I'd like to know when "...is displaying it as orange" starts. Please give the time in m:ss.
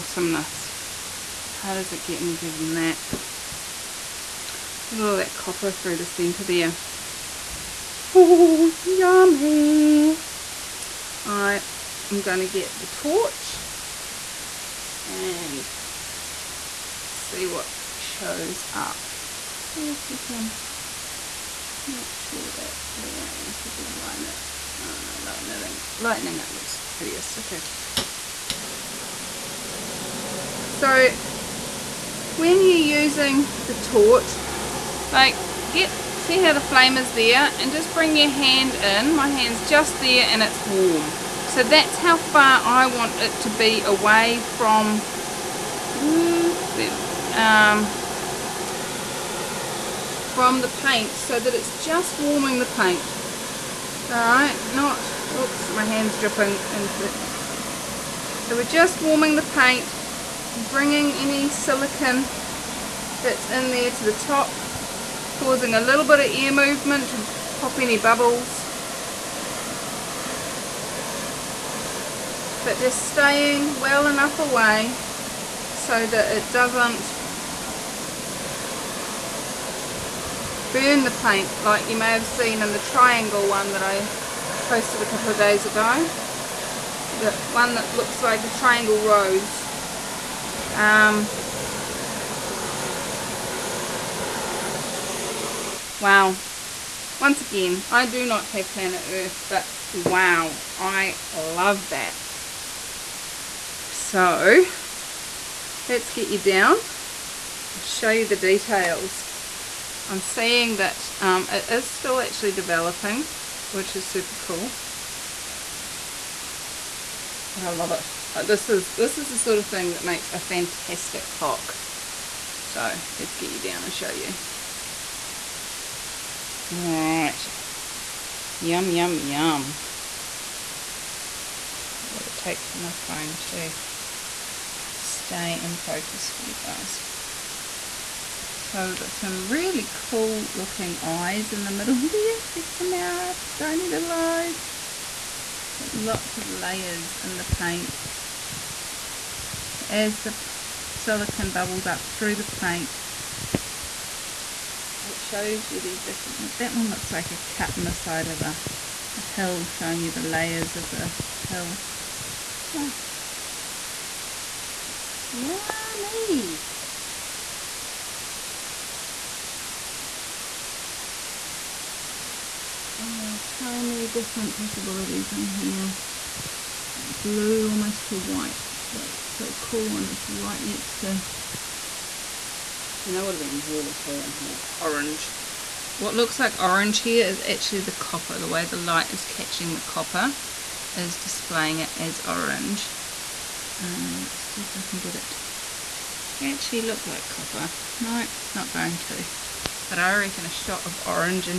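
3:10.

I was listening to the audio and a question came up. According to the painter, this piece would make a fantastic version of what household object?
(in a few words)
Clock.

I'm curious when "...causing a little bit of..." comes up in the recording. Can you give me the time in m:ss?
1:05.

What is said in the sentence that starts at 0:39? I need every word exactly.
My hand's just there and it's warm.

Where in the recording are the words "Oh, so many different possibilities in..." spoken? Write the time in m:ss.
2:52.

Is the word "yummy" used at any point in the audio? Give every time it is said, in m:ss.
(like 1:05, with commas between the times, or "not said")
0:08, 2:45.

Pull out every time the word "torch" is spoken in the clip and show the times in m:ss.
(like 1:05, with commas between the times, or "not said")
0:12, 0:33.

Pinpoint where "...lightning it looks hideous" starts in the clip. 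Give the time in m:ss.
0:25.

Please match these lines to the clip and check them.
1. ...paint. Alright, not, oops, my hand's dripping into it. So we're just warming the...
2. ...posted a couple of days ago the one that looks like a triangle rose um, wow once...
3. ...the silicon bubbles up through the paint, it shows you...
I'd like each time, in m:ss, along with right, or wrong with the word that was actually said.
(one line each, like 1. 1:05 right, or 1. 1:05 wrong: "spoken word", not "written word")
1. 0:52 right
2. 1:24 right
3. 2:30 right.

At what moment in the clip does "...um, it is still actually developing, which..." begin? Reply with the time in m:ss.
1:51.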